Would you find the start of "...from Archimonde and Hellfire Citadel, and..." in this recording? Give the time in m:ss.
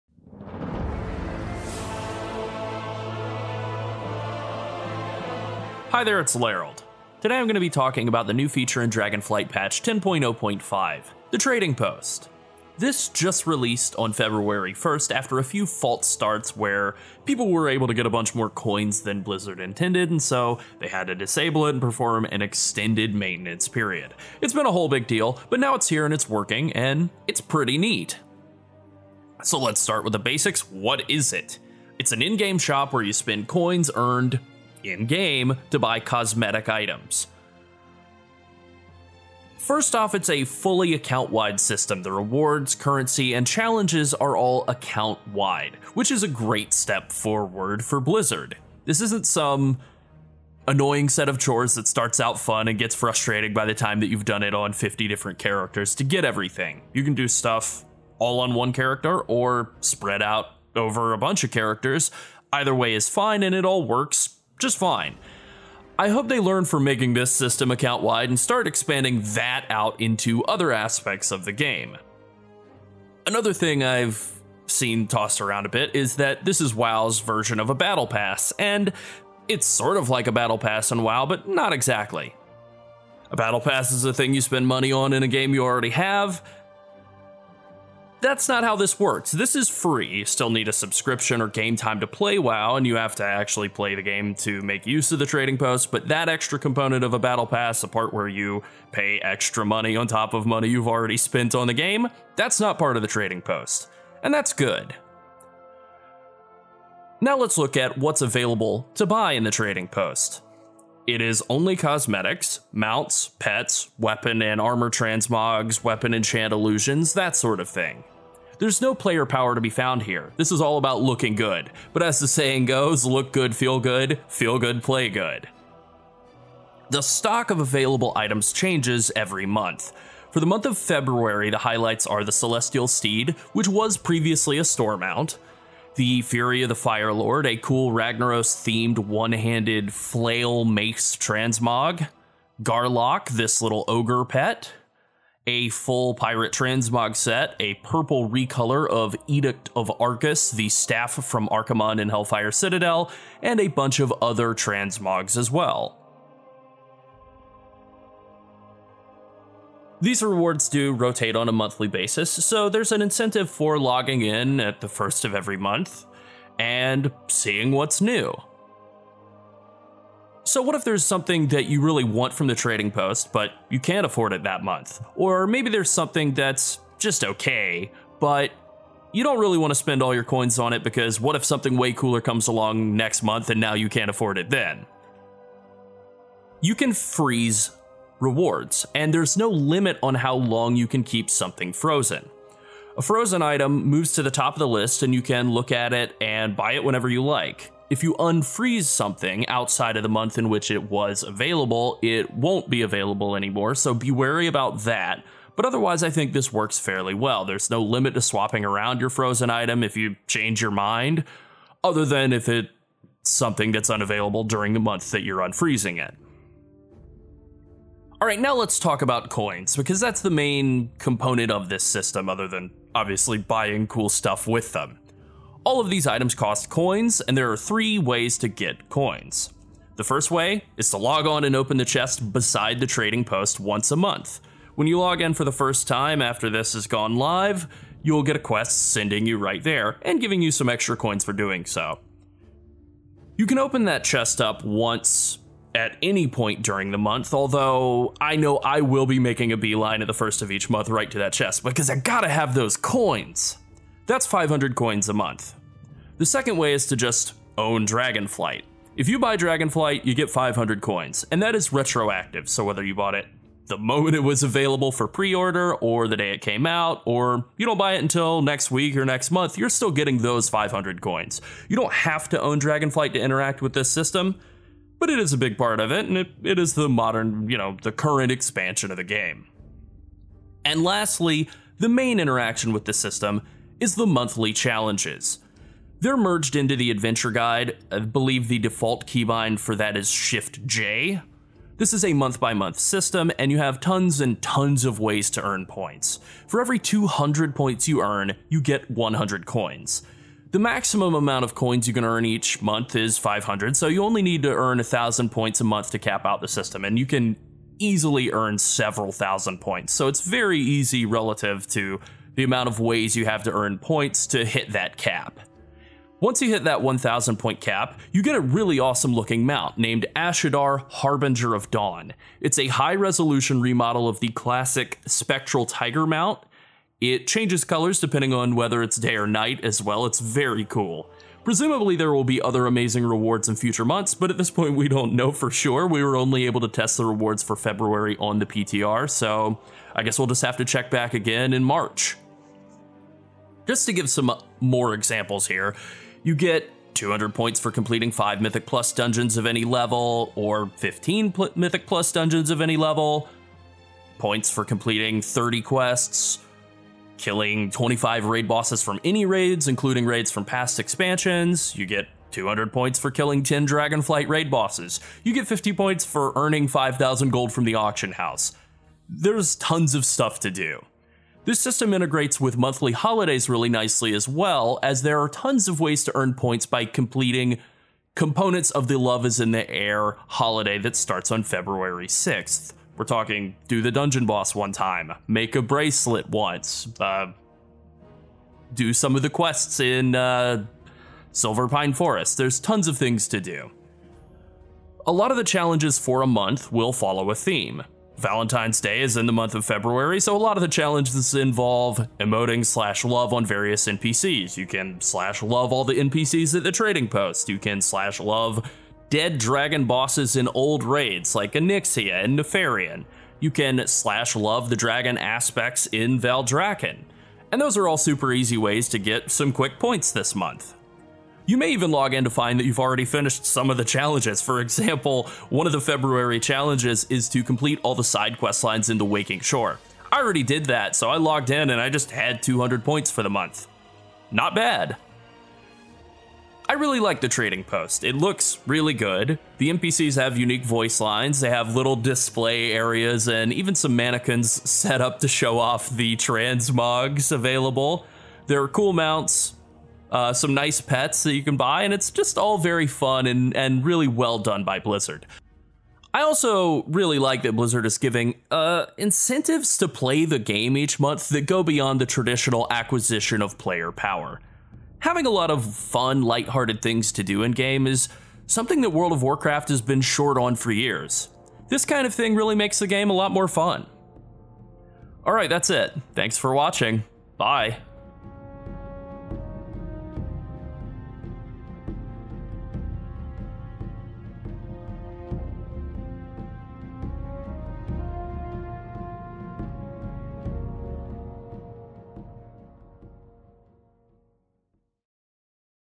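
2:31.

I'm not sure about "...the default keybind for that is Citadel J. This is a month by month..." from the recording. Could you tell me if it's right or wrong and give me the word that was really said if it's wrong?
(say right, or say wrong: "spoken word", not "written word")
wrong: "Shift", not "Citadel".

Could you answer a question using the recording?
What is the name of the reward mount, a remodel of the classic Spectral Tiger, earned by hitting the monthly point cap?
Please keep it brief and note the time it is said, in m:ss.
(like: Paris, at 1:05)
Ash'adar Harbinger of Dawn, at 5:20.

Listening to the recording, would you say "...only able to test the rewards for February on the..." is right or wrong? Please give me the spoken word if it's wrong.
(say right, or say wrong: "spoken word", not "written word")
right.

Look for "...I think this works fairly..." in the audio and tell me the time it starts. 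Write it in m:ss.
3:26.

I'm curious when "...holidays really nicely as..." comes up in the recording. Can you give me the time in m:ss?
6:12.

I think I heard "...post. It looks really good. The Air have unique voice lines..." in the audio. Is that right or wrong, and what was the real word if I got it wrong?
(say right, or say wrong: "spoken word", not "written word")
wrong: "NPCs", not "Air".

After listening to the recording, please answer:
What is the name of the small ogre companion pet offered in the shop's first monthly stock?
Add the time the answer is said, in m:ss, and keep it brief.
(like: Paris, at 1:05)
Garlock, at 2:22.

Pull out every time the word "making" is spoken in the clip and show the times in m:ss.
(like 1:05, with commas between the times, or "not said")
1:06, 4:09.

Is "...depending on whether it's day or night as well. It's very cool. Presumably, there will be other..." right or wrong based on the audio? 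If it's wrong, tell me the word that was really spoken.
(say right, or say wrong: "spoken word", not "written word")
right.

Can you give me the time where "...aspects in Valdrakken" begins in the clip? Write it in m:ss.
6:55.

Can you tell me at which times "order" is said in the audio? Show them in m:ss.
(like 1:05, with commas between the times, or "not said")
4:25.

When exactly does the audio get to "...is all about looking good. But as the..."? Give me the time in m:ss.
2:00.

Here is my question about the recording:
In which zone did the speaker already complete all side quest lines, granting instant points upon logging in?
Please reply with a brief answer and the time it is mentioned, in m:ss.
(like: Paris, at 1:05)
Waking Shore, at 7:09.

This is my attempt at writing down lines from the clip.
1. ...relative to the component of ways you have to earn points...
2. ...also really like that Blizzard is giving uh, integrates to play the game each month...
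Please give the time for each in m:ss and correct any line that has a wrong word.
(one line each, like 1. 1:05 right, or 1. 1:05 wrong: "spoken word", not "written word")
1. 5:11 wrong: "amount", not "component"
2. 7:36 wrong: "incentives", not "integrates".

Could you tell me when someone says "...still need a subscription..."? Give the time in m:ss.
1:30.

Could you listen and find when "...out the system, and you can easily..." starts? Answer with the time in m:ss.
5:06.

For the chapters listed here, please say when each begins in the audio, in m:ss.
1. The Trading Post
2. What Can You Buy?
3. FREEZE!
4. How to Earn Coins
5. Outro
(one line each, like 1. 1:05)
1. 0:28
2. 1:48
3. 2:50
4. 3:37
5. 7:16.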